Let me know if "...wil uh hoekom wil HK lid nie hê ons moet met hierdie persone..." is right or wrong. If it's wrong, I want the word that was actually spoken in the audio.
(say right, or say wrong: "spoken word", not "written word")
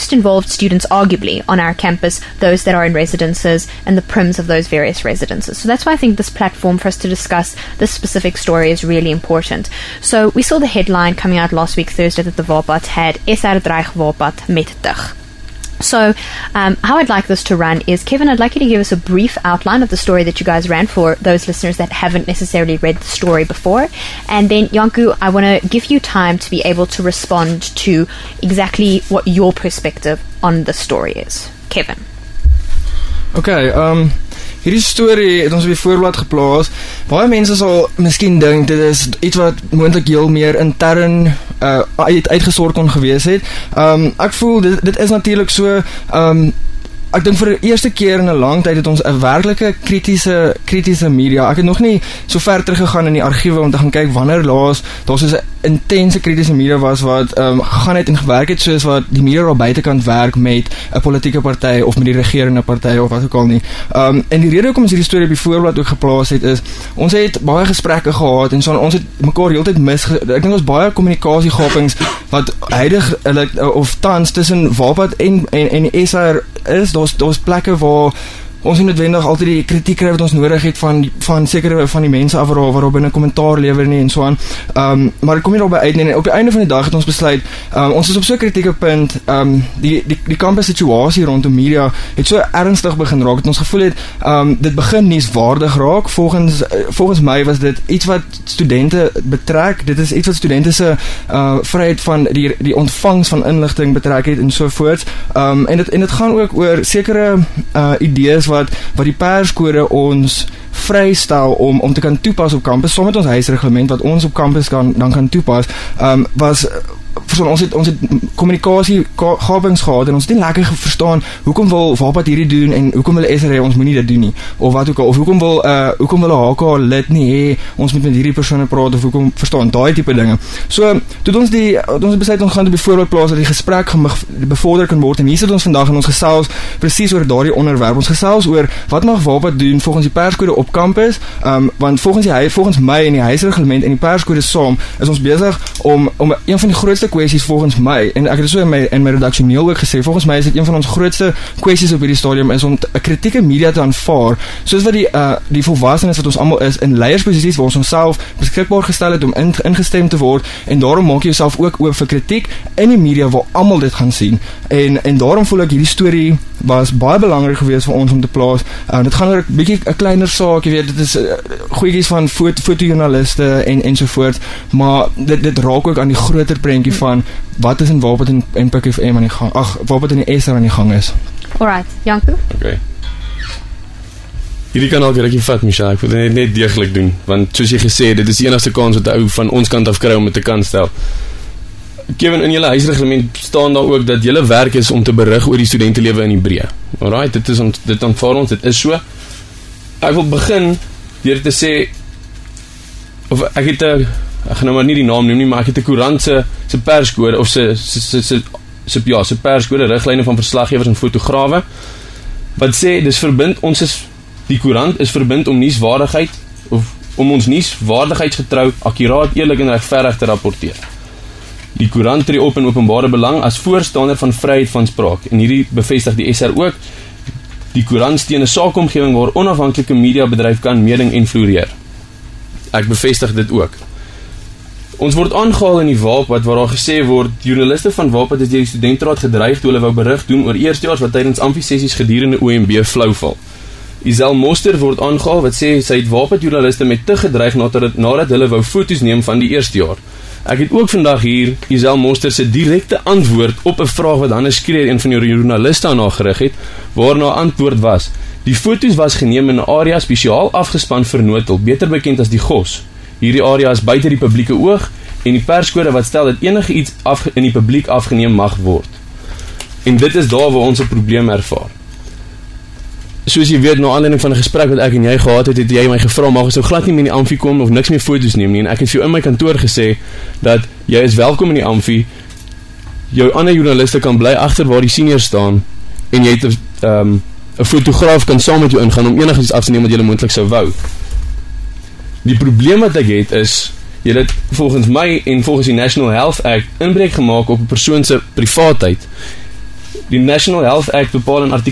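right.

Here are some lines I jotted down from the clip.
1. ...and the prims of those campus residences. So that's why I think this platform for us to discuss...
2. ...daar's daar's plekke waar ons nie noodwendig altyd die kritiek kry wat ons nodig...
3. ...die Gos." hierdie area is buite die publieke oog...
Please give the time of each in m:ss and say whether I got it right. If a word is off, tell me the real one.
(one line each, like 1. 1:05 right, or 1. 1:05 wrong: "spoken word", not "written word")
1. 0:03 wrong: "various", not "campus"
2. 1:16 right
3. 4:22 right.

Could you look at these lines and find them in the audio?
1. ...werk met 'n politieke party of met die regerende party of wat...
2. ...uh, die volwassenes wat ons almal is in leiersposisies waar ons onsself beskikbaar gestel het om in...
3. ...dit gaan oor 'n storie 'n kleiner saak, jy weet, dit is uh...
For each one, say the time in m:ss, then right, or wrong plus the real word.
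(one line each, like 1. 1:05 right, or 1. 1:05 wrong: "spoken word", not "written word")
1. 1:00 right
2. 2:35 right
3. 2:49 wrong: "bietjie", not "storie".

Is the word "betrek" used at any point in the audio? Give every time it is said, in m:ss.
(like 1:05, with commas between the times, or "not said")
1:39, 1:43.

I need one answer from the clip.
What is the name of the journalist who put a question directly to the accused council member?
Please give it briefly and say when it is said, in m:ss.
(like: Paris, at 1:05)
Hannes Skreer, at 4:14.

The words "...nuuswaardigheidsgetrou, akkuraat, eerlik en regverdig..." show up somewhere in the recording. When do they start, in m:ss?
3:37.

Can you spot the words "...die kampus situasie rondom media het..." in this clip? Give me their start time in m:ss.
1:30.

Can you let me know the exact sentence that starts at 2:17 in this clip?
Ons gesels oor wat mag Wapad doen volgens die perskode op kampus.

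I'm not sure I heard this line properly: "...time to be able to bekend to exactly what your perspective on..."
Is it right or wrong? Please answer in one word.
wrong.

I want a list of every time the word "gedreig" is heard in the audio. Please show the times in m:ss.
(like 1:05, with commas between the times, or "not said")
3:59, 4:07.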